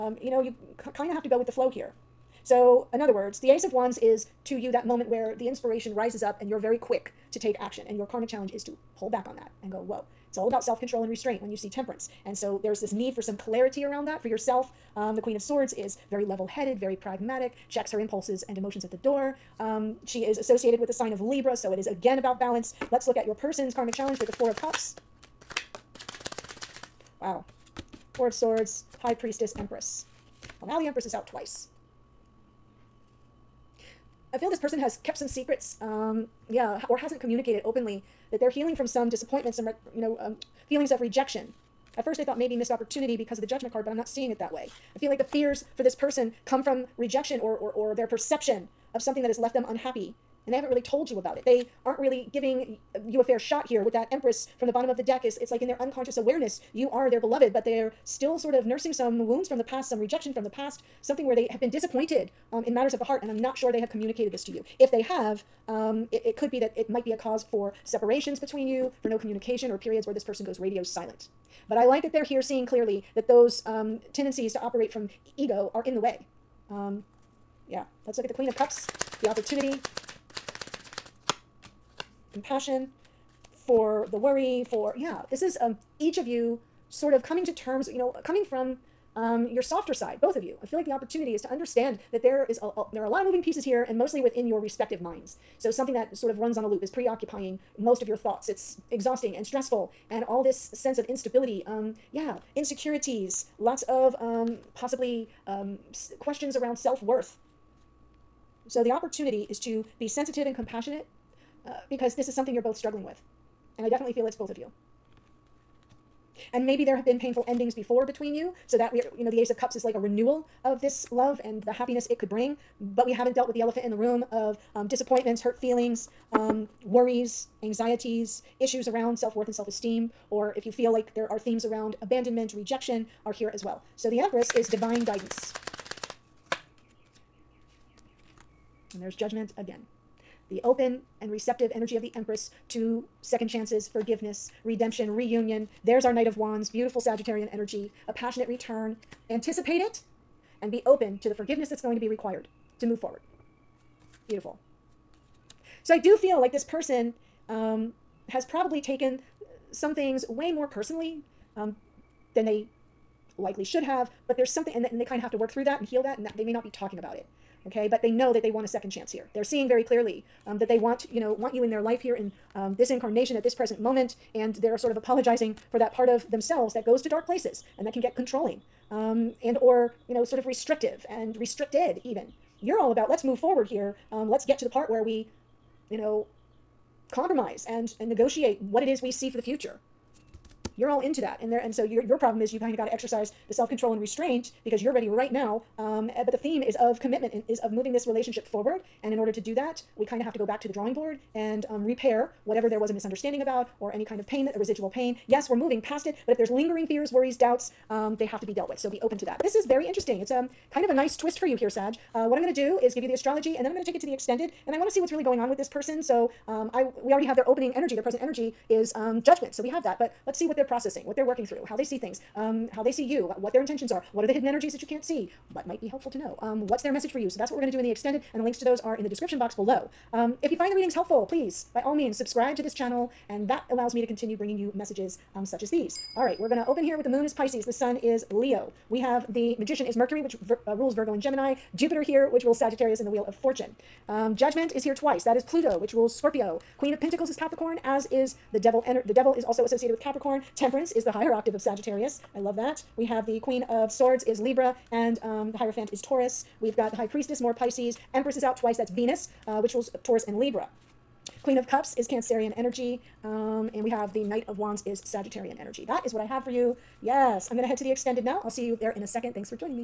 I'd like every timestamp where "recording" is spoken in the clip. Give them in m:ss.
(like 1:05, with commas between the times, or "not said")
not said.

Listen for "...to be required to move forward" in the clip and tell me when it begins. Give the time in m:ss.
2:31.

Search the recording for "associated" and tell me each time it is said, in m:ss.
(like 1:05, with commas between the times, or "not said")
0:20, 4:09.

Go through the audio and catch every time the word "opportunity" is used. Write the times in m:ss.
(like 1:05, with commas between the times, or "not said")
0:42, 1:19, 1:30, 1:48.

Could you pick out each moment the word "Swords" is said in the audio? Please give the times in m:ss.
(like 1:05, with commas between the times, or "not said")
0:15, 0:28, 4:13.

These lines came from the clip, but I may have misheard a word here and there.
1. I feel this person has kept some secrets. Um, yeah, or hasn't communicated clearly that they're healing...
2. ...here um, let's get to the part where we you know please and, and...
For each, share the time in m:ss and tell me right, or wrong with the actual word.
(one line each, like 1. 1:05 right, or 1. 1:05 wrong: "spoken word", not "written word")
1. 0:34 wrong: "openly", not "clearly"
2. 3:03 wrong: "compromise", not "please".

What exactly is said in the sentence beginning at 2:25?
There's our Knight of Wands, beautiful Sagittarian energy, a passionate return.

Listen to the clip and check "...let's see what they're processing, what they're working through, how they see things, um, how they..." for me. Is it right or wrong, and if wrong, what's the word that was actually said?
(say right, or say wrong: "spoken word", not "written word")
right.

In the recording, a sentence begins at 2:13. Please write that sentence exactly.
So the Empress is divine guidance.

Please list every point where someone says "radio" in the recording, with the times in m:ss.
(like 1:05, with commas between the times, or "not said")
1:10.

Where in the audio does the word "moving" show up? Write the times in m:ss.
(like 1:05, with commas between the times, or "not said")
1:33, 3:17, 3:25.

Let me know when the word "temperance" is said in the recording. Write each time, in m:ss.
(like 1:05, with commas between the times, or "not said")
0:11, 4:10.